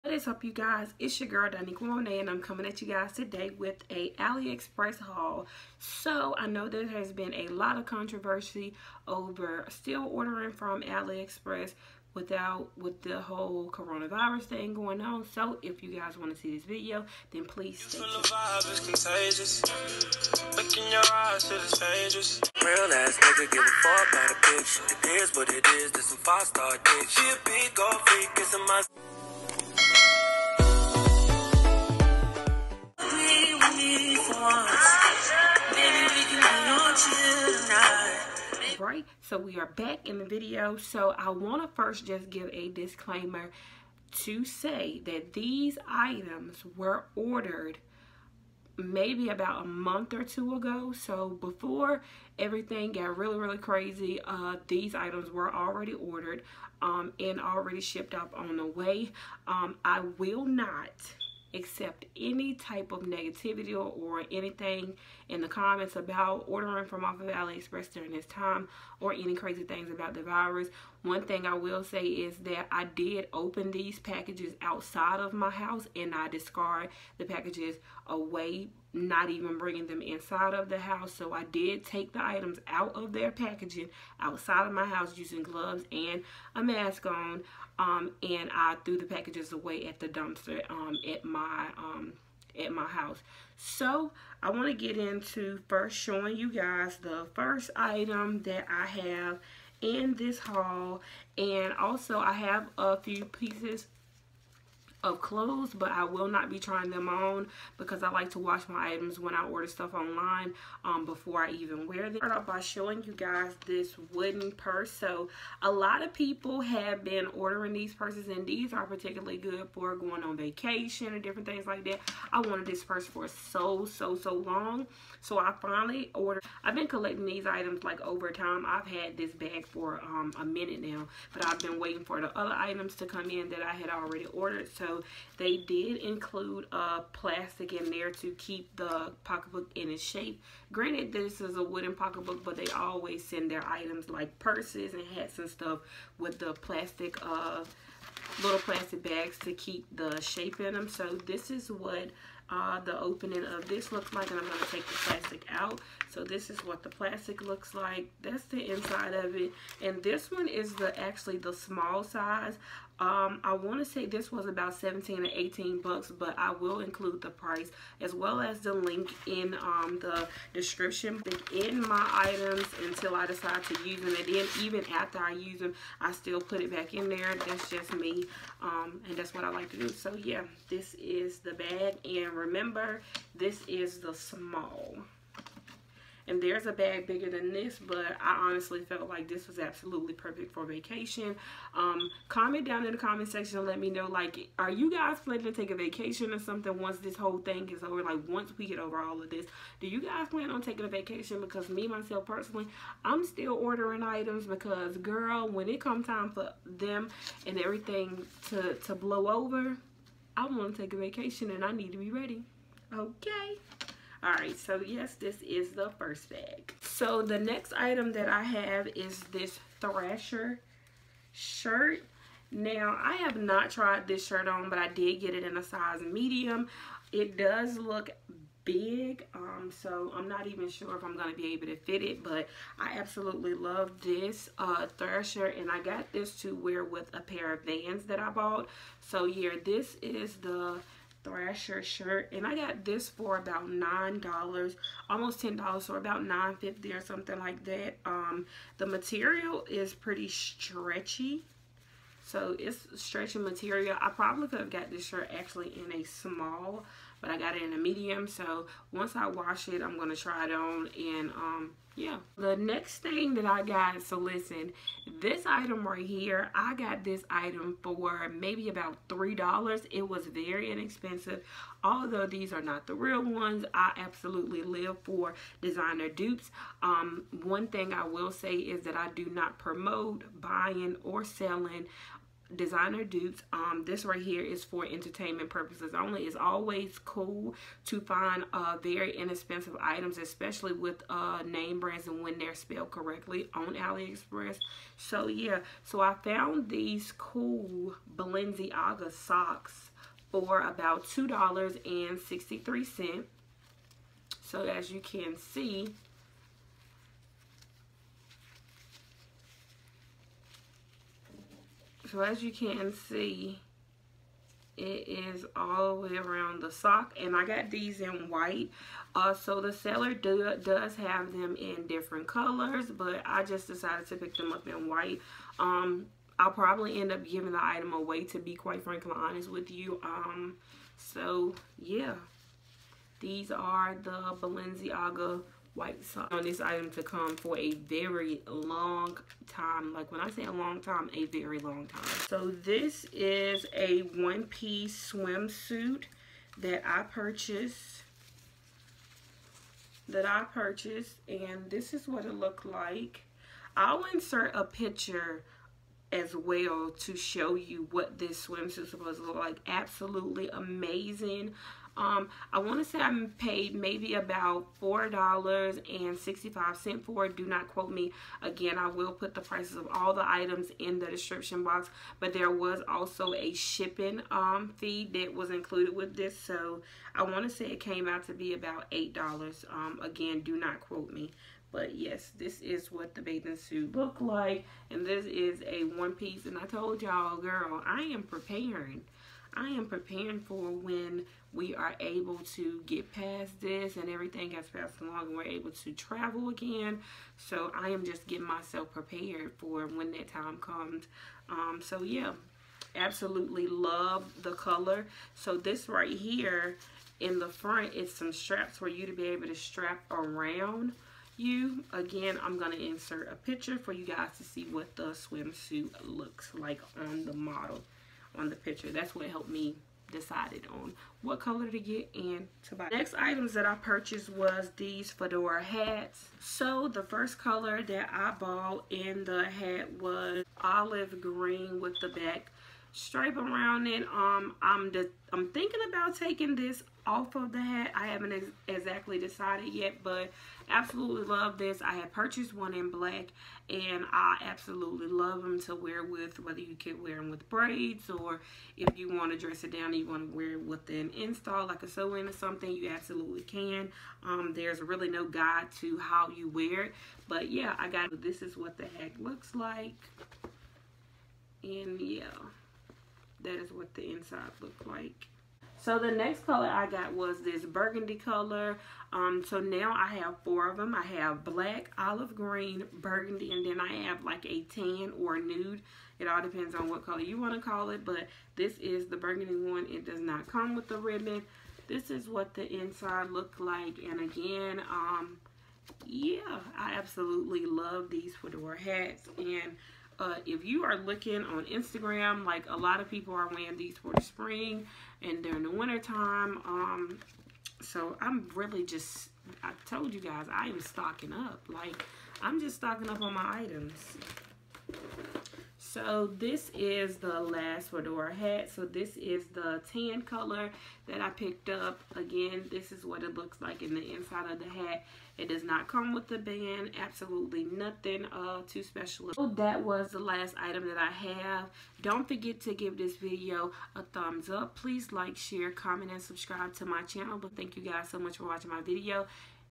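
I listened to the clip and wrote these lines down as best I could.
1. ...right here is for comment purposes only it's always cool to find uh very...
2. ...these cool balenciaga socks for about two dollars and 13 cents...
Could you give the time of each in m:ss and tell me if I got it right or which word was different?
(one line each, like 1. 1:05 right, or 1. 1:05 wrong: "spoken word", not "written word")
1. 4:44 wrong: "entertainment", not "comment"
2. 4:56 wrong: "63", not "13".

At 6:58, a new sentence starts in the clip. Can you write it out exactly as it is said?
That's what helped me decided on what color to get and to buy.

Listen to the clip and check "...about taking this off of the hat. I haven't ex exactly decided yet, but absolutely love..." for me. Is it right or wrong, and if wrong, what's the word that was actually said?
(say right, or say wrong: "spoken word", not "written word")
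right.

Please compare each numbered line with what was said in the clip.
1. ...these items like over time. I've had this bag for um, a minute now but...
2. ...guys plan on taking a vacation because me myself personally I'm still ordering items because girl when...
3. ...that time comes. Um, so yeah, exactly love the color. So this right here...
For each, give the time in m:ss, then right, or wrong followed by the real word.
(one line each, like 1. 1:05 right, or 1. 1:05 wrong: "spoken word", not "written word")
1. 2:07 right
2. 3:20 right
3. 6:40 wrong: "absolutely", not "exactly".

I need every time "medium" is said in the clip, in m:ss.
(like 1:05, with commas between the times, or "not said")
3:46, 4:17.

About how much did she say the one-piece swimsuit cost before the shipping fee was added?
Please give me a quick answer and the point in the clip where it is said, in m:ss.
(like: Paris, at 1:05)
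$4.65, at 6:04.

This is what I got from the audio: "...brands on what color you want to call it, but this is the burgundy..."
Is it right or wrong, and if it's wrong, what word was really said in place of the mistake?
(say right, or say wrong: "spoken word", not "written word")
wrong: "depends", not "brands".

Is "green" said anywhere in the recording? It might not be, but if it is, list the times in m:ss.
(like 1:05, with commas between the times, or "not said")
7:11, 7:52.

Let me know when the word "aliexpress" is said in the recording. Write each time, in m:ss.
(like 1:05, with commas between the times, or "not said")
0:04, 0:10, 1:07, 4:53.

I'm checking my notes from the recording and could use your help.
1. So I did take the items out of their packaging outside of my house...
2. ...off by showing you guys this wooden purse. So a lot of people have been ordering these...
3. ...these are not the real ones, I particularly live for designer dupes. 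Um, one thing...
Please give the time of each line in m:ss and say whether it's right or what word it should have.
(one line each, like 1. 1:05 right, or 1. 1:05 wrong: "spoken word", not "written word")
1. 1:21 right
2. 1:52 right
3. 4:32 wrong: "absolutely", not "particularly".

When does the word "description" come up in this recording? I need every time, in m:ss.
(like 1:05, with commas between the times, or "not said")
2:50, 6:11.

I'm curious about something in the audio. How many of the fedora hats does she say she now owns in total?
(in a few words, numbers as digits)
4.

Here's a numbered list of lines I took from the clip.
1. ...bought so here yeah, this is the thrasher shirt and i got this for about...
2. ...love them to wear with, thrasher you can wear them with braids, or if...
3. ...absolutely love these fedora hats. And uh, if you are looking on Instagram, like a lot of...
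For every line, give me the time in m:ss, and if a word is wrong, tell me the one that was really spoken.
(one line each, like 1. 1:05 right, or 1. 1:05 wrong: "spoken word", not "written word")
1. 3:58 right
2. 7:25 wrong: "whether", not "thrasher"
3. 8:06 right.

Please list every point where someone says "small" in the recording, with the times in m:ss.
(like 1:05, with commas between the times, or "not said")
2:41, 3:04, 4:16.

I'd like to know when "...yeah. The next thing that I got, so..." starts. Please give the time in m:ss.
4:21.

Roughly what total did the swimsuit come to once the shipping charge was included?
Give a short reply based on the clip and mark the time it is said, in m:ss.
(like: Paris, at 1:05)
$8, at 6:18.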